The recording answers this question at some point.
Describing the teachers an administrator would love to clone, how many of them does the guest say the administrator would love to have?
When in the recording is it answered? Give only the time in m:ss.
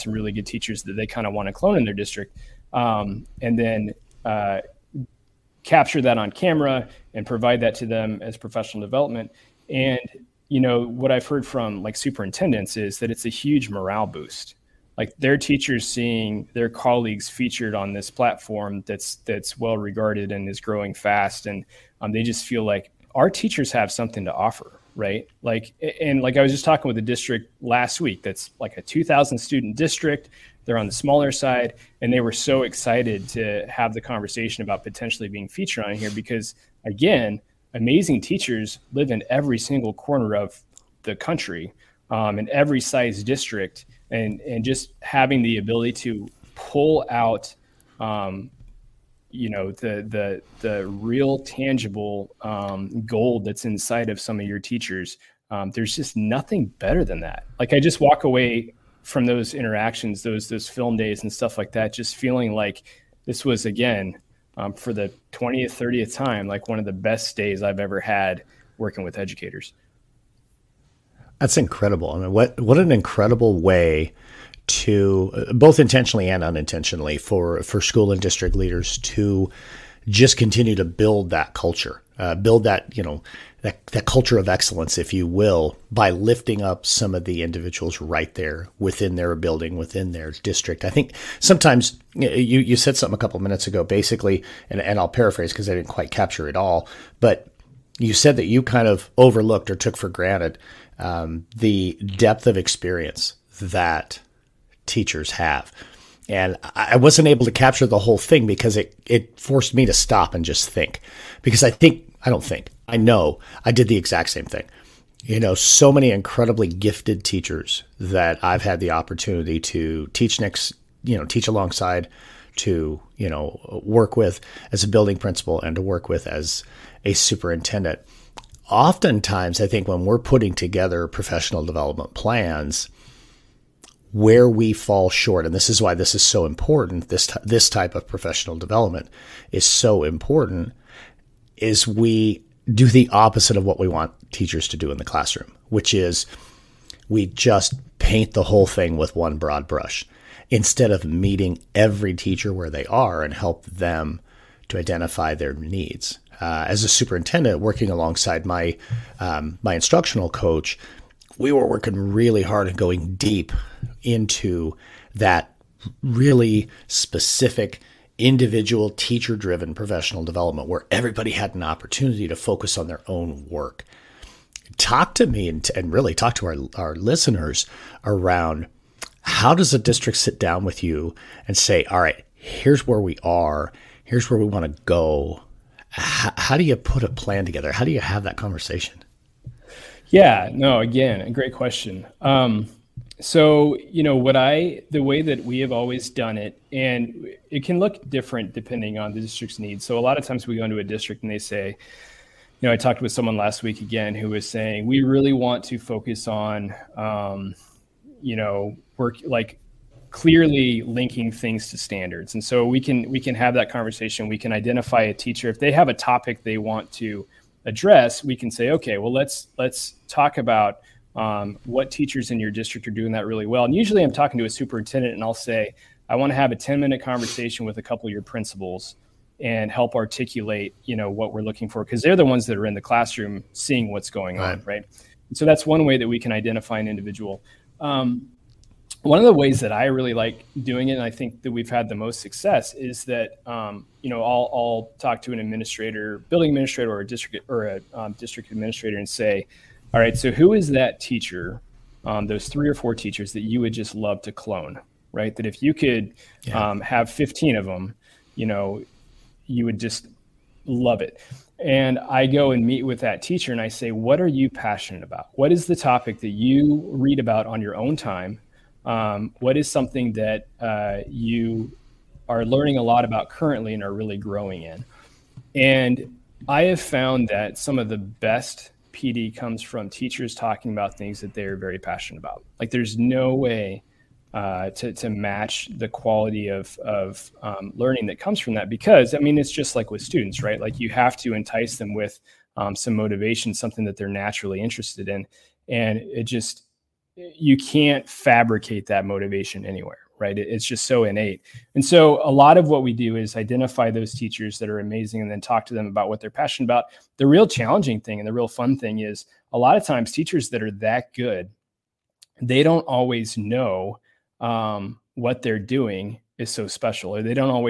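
4:17.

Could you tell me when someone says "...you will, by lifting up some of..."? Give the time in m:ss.
1:25.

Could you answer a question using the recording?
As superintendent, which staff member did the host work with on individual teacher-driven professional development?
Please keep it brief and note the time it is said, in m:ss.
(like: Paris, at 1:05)
instructional coach, at 2:39.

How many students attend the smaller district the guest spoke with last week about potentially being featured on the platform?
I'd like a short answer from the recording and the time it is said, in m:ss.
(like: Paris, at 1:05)
2000, at 0:28.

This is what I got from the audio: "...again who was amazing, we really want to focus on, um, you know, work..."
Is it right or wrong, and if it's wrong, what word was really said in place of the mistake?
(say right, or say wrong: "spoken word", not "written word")
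wrong: "saying", not "amazing".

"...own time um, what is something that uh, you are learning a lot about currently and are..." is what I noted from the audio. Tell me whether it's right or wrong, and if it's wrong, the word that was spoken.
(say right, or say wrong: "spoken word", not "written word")
right.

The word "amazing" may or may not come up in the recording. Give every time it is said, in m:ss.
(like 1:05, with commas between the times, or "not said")
0:37, 5:04.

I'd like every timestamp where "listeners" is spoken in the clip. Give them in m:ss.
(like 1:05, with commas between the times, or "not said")
2:56.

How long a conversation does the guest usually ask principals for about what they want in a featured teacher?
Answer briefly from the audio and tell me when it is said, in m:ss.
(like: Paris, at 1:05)
10 minute, at 3:46.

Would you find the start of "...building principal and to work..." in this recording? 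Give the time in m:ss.
2:04.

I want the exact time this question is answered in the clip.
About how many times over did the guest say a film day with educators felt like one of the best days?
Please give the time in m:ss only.
1:05.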